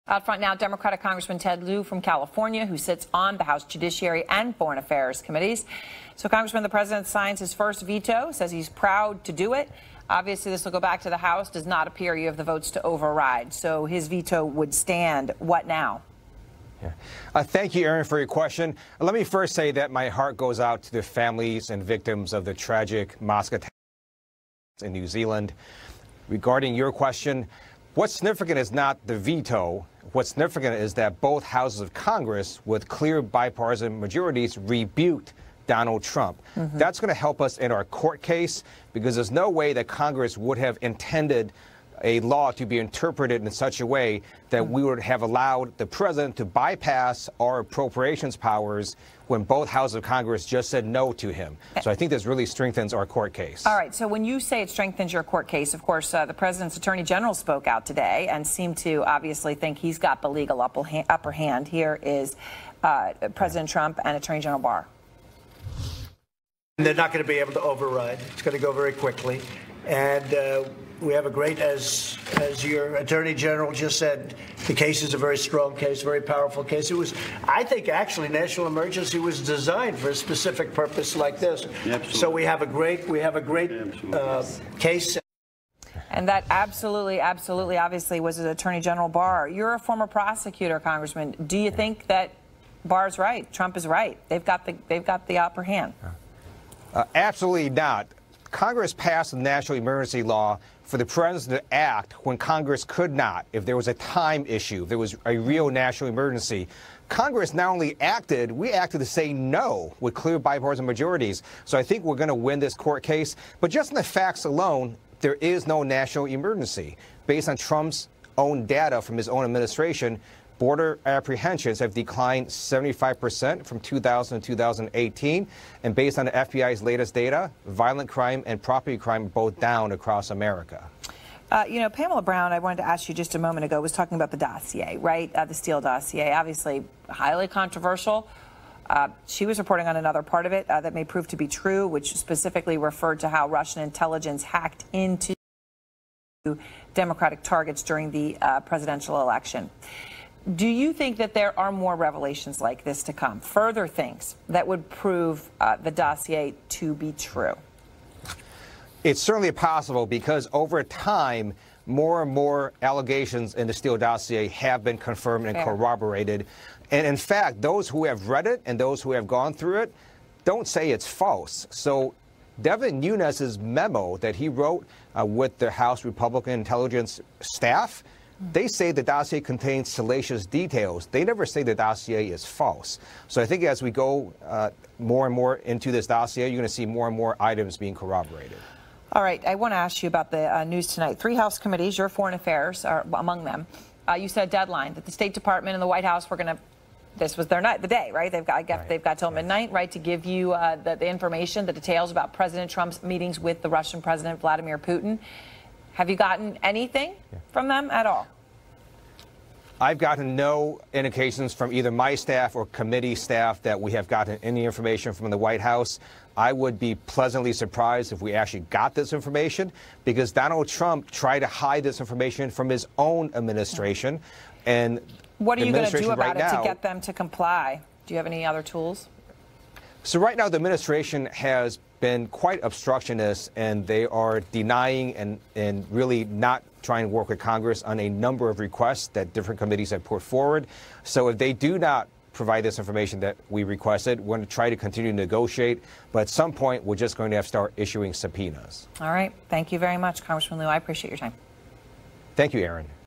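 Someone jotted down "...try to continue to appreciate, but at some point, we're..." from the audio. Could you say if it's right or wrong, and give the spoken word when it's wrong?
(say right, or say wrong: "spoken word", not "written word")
wrong: "negotiate", not "appreciate".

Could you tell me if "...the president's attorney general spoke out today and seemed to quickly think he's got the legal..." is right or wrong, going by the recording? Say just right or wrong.
wrong.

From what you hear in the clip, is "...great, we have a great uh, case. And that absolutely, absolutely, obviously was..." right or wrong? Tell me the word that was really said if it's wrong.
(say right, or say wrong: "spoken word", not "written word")
right.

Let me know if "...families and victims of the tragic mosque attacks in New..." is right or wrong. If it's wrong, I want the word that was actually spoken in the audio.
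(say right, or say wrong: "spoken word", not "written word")
right.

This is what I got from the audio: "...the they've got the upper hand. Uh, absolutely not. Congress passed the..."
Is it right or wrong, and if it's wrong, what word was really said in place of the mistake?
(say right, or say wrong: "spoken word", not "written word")
right.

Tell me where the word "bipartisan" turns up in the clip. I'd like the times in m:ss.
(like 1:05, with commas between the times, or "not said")
0:33, 1:50.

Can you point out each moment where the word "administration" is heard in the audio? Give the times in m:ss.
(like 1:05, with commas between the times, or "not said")
1:59, 3:43, 3:50.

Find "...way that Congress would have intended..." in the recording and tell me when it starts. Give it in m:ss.
0:39.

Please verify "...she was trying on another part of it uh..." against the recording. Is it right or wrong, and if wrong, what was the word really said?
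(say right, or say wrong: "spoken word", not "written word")
wrong: "reporting", not "trying".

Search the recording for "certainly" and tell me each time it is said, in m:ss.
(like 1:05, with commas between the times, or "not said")
2:39.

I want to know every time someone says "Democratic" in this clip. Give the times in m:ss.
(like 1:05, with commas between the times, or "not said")
0:00, 2:26.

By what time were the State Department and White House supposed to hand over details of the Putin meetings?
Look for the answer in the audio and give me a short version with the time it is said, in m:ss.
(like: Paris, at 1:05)
Midnight, at 3:19.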